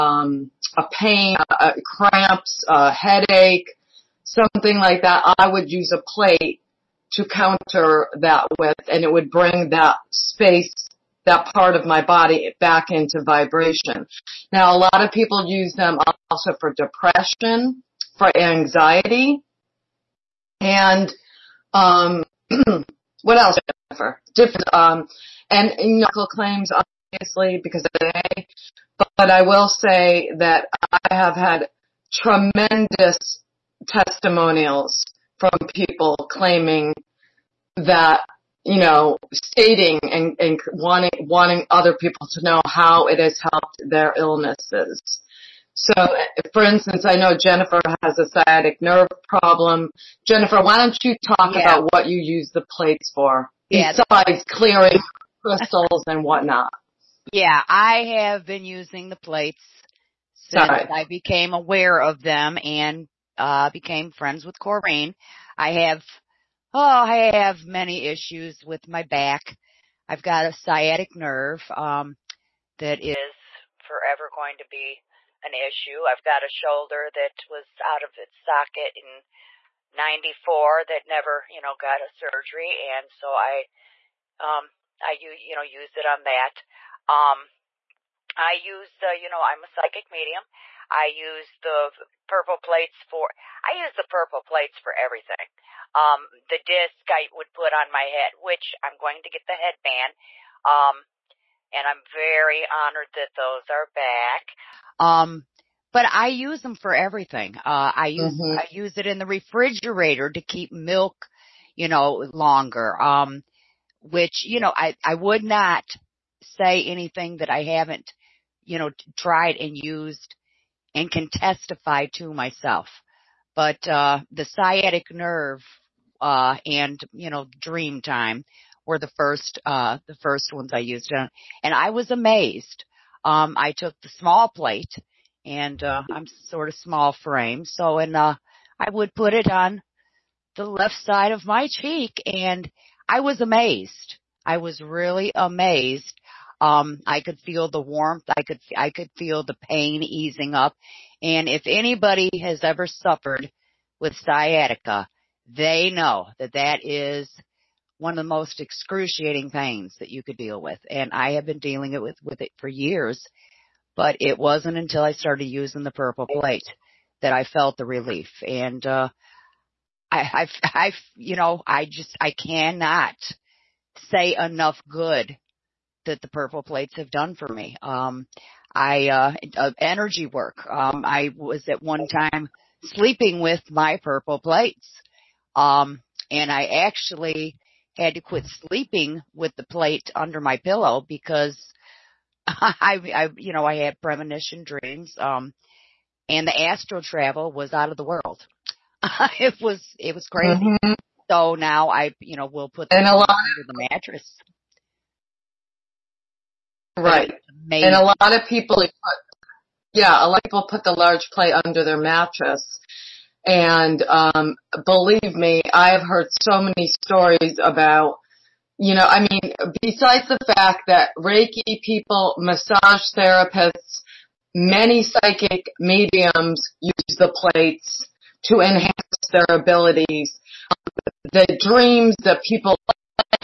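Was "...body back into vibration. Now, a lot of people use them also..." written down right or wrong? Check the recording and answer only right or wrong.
right.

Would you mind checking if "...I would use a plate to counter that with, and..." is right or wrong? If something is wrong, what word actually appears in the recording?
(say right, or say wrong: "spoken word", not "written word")
right.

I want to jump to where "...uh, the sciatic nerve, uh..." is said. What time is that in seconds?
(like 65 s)
123 s.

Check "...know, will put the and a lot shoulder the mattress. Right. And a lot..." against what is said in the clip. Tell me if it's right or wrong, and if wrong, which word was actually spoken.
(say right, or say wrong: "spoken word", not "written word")
wrong: "under", not "shoulder".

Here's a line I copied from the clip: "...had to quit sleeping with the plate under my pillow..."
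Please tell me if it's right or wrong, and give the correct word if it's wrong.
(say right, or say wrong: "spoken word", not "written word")
right.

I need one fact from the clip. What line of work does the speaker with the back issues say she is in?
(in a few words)
Psychic medium.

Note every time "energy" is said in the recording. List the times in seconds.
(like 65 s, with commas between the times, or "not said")
179 s.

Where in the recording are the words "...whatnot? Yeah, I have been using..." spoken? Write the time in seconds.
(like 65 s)
56 s.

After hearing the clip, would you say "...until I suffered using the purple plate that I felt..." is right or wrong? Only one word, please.
wrong.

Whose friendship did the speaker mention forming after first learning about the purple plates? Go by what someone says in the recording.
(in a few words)
Corrine.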